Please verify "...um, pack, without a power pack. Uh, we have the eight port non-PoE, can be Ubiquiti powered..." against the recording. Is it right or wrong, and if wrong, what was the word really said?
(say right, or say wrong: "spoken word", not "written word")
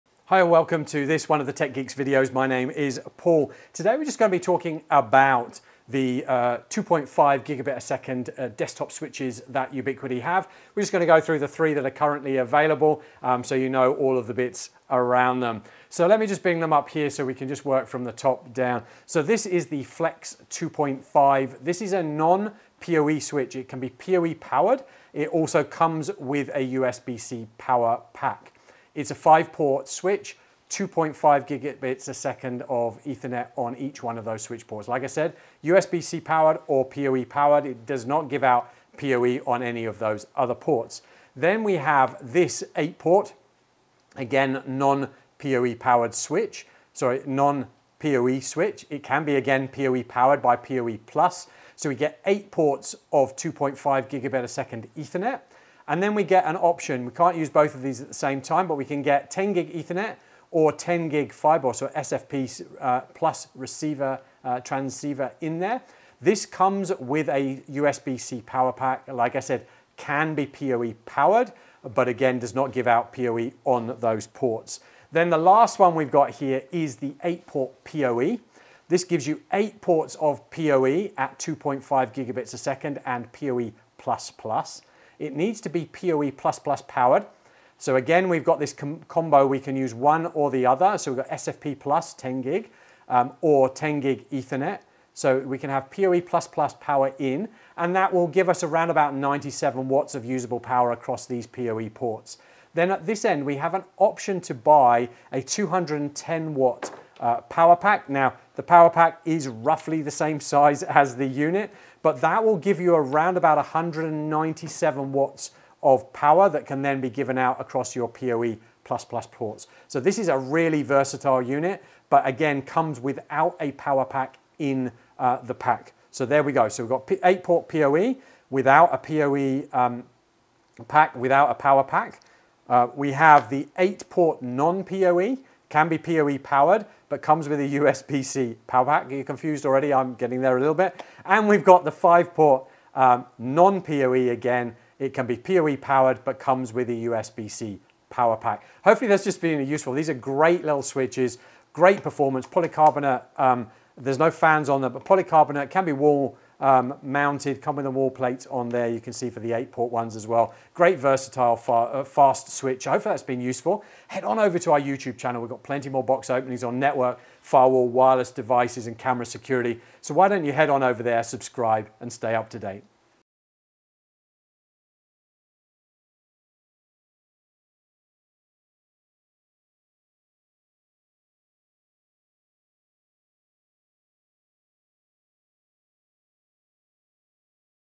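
wrong: "PoE", not "Ubiquiti".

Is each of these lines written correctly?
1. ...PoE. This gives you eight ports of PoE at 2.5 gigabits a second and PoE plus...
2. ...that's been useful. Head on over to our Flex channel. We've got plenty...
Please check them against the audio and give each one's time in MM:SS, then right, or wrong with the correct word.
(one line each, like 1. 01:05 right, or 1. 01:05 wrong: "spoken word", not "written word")
1. 01:17 right
2. 02:43 wrong: "YouTube", not "Flex".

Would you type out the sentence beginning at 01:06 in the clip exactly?
This comes with a USB-C power pack.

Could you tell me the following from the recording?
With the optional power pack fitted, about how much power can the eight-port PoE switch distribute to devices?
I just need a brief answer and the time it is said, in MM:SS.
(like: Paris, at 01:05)
197 watts, at 01:53.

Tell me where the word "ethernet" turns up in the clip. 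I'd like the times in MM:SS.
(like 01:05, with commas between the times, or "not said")
00:33, 00:54, 00:59, 01:34.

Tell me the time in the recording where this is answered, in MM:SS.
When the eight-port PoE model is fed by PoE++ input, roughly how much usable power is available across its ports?
01:39.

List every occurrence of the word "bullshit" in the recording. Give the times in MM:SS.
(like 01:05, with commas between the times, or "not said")
not said.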